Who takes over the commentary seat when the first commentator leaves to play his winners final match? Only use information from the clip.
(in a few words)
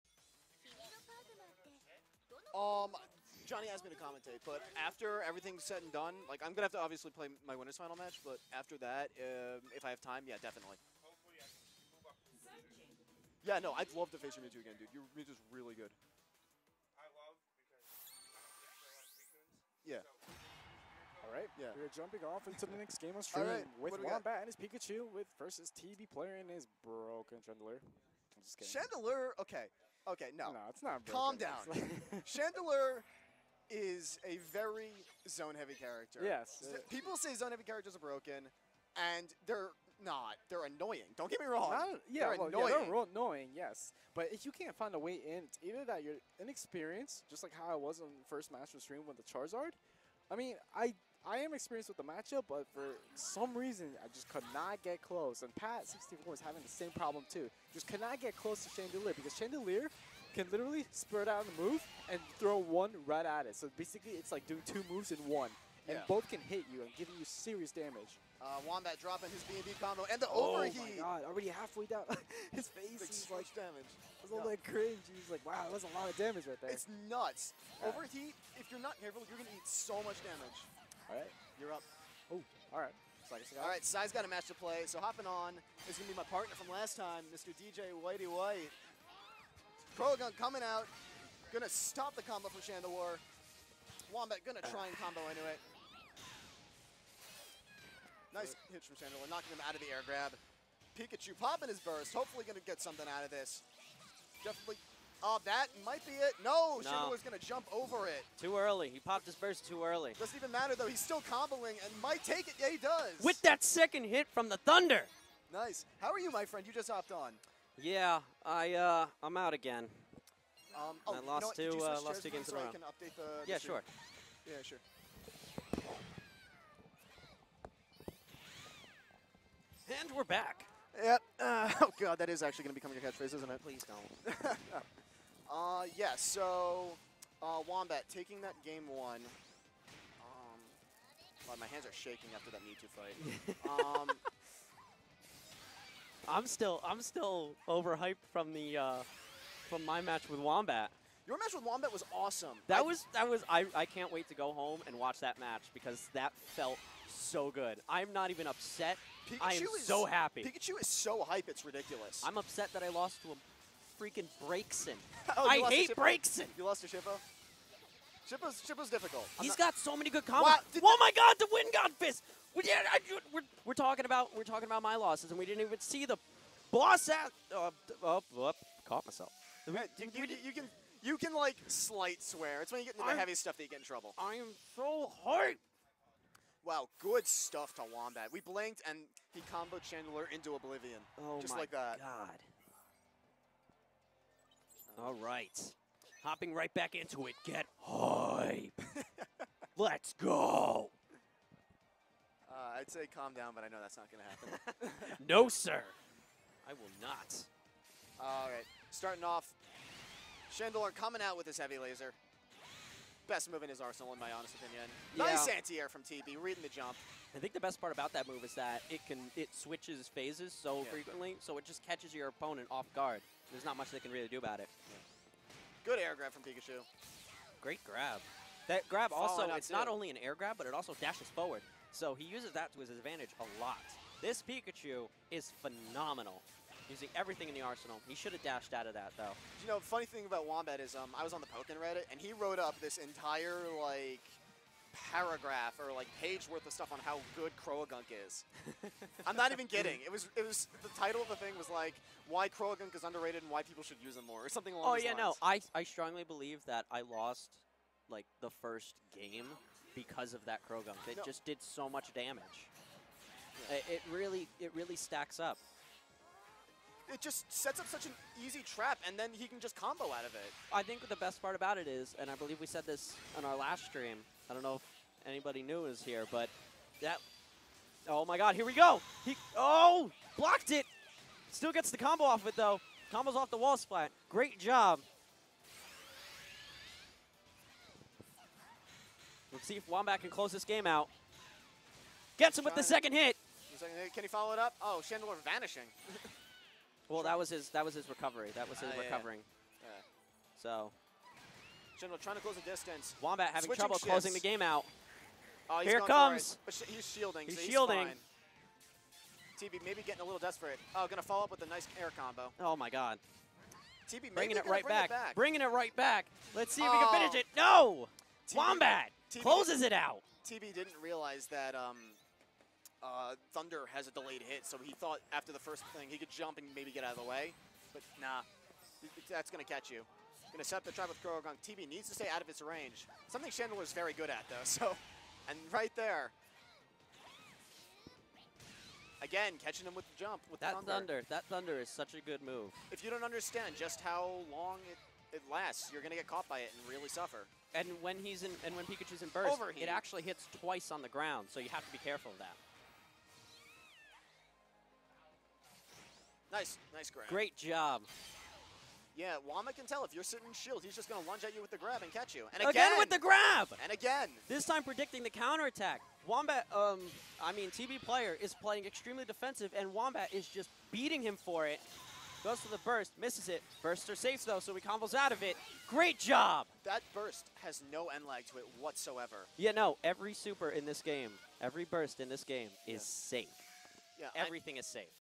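DJ Whitey White.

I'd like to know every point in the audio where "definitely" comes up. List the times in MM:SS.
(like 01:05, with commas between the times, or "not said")
00:10, 01:44.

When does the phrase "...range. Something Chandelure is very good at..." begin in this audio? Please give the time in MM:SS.
05:32.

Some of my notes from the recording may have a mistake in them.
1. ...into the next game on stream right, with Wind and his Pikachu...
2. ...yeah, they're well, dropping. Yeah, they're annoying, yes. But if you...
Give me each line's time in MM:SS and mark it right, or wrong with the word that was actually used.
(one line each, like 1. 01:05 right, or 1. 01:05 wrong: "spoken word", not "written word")
1. 00:22 wrong: "Wombat", not "Wind"
2. 00:42 wrong: "annoying", not "dropping".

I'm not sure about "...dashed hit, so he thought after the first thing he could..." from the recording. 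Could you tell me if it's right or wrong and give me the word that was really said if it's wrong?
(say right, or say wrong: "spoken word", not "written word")
wrong: "delayed", not "dashed".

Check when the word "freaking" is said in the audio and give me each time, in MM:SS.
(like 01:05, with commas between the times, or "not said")
02:44.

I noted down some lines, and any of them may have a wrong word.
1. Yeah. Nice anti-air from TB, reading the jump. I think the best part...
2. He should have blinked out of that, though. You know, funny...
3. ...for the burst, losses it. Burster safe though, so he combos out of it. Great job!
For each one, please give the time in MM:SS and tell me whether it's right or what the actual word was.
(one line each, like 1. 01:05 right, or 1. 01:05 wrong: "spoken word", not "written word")
1. 03:35 right
2. 03:58 wrong: "dashed", not "blinked"
3. 06:12 wrong: "misses", not "losses".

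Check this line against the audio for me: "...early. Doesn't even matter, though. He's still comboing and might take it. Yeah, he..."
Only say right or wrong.
right.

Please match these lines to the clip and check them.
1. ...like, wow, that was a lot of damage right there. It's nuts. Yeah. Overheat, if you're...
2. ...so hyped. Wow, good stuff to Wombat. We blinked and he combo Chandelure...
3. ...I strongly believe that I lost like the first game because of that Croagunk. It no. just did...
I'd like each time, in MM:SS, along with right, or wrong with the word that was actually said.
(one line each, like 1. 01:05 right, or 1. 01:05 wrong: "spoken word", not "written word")
1. 01:15 right
2. 03:04 right
3. 04:15 right.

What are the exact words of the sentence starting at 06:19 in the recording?
Yeah, no, every super in this game, every burst in this game is yeah.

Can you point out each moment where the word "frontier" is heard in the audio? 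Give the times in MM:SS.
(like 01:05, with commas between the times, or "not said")
not said.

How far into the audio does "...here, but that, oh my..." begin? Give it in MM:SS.
04:36.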